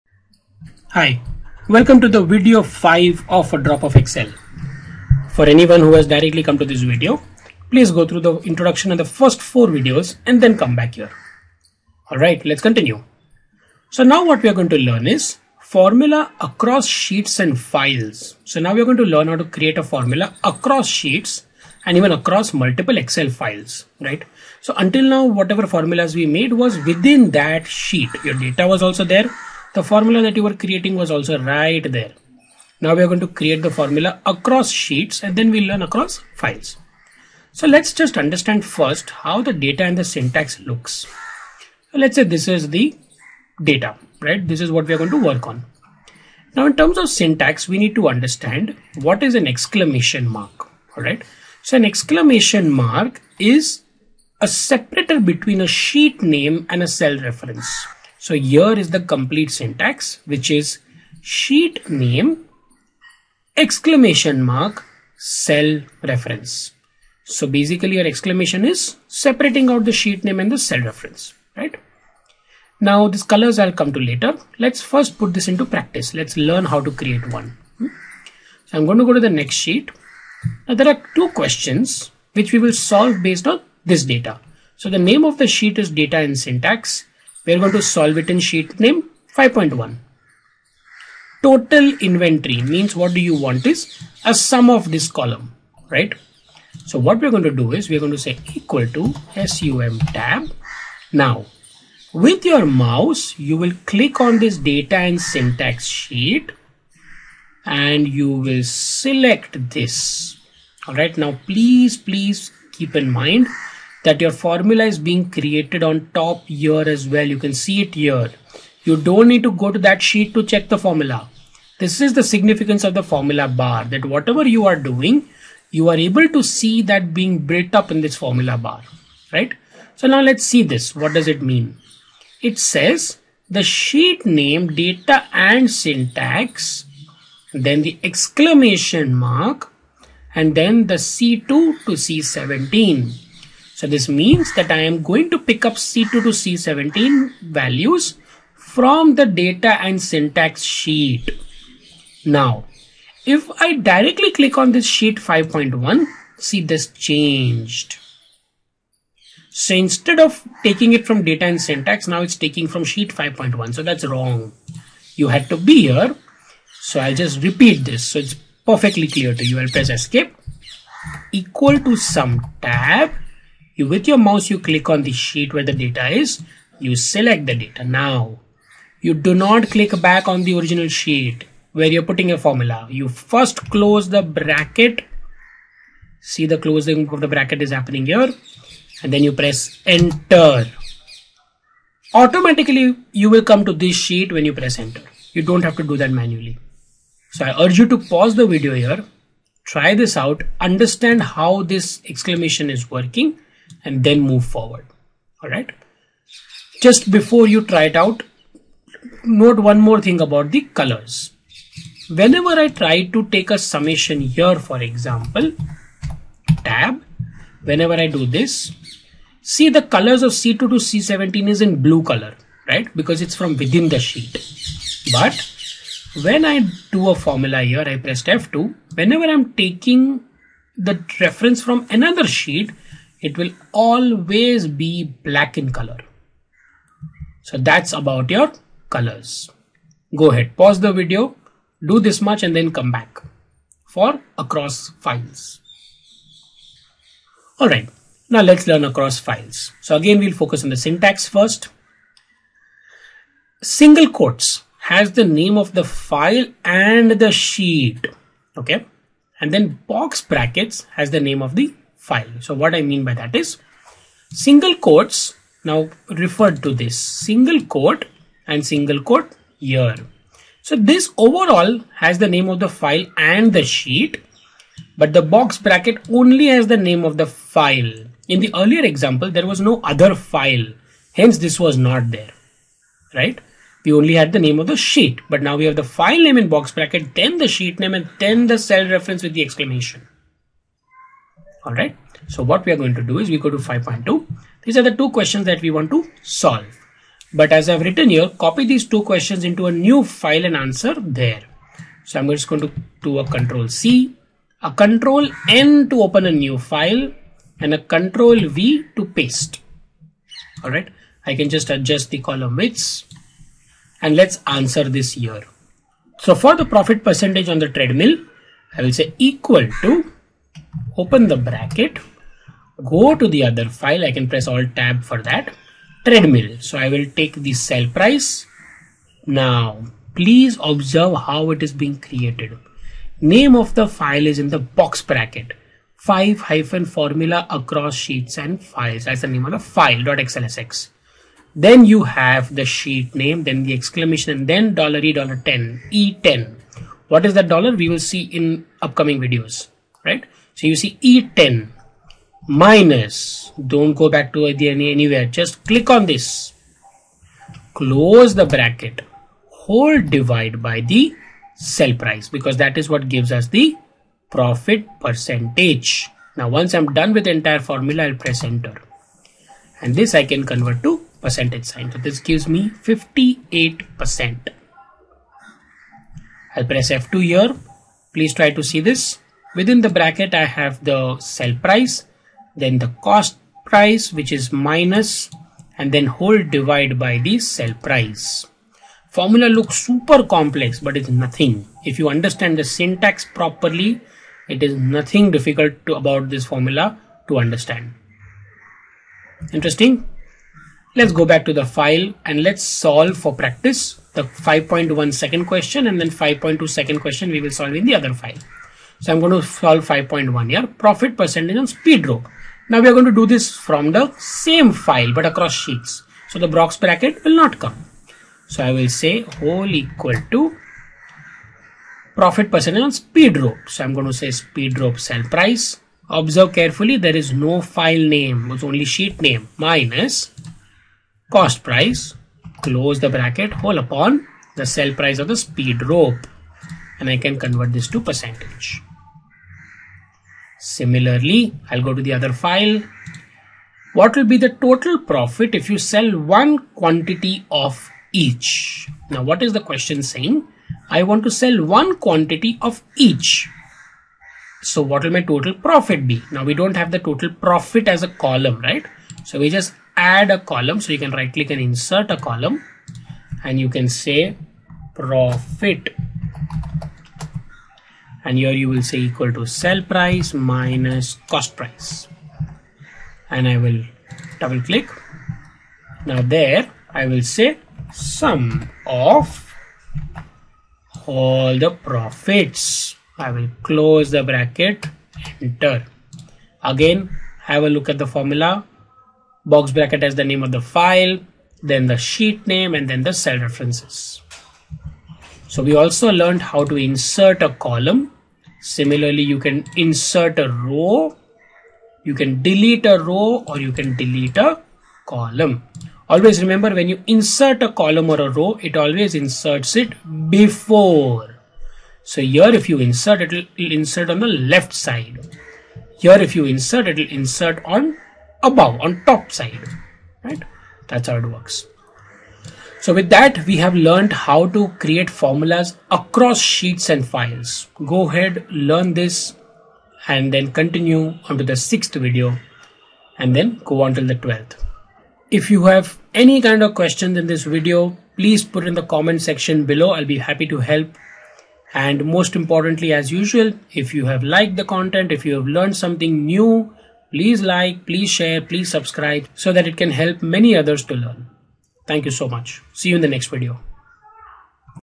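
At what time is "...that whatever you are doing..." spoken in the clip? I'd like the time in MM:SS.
02:03.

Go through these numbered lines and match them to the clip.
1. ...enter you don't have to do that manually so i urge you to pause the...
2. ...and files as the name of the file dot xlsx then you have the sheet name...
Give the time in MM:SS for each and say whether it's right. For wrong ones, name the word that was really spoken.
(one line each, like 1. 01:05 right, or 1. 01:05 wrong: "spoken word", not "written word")
1. 03:14 right
2. 05:38 right.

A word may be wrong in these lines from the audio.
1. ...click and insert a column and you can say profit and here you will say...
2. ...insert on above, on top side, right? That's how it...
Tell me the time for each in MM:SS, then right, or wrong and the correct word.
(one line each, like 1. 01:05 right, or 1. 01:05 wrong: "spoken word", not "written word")
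1. 07:41 right
2. 08:37 right.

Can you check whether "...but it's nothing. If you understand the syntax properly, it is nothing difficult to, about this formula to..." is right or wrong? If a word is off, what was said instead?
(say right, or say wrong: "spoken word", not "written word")
right.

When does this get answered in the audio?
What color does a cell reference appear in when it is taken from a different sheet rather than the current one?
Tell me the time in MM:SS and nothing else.
03:55.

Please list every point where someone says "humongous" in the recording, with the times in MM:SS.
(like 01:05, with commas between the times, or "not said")
not said.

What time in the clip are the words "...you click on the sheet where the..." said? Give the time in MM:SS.
02:54.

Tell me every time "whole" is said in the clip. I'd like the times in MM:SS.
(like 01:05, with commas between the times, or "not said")
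05:59, 06:26, 06:59, 07:13.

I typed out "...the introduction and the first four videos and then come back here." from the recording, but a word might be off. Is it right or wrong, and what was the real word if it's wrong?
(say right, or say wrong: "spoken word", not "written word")
right.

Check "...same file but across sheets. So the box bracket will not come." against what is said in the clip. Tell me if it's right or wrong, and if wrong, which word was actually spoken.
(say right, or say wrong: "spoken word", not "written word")
right.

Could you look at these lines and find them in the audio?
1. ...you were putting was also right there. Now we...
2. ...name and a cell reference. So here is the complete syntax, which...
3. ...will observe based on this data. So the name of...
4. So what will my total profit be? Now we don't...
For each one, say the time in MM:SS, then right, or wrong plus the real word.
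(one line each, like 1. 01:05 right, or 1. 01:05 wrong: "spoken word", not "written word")
1. 00:30 wrong: "creating", not "putting"
2. 00:56 right
3. 01:22 wrong: "solve", not "observe"
4. 07:34 right.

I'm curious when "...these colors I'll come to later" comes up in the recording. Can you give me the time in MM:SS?
01:13.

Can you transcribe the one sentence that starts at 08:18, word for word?
Similarly, you can insert a row, you can delete a row or you can delete a column.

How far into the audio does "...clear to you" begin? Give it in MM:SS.
02:49.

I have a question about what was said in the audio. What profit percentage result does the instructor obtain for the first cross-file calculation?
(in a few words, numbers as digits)
58%.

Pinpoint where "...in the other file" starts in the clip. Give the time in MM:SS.
06:47.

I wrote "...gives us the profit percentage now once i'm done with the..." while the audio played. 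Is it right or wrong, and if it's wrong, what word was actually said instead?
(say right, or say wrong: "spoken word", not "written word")
right.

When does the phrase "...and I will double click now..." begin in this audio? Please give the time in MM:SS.
07:53.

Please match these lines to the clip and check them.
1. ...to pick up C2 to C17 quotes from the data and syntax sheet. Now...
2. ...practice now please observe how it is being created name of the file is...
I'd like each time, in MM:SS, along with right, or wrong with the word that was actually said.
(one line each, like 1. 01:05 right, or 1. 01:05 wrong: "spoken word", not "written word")
1. 02:25 wrong: "values", not "quotes"
2. 05:27 wrong: "price", not "practice".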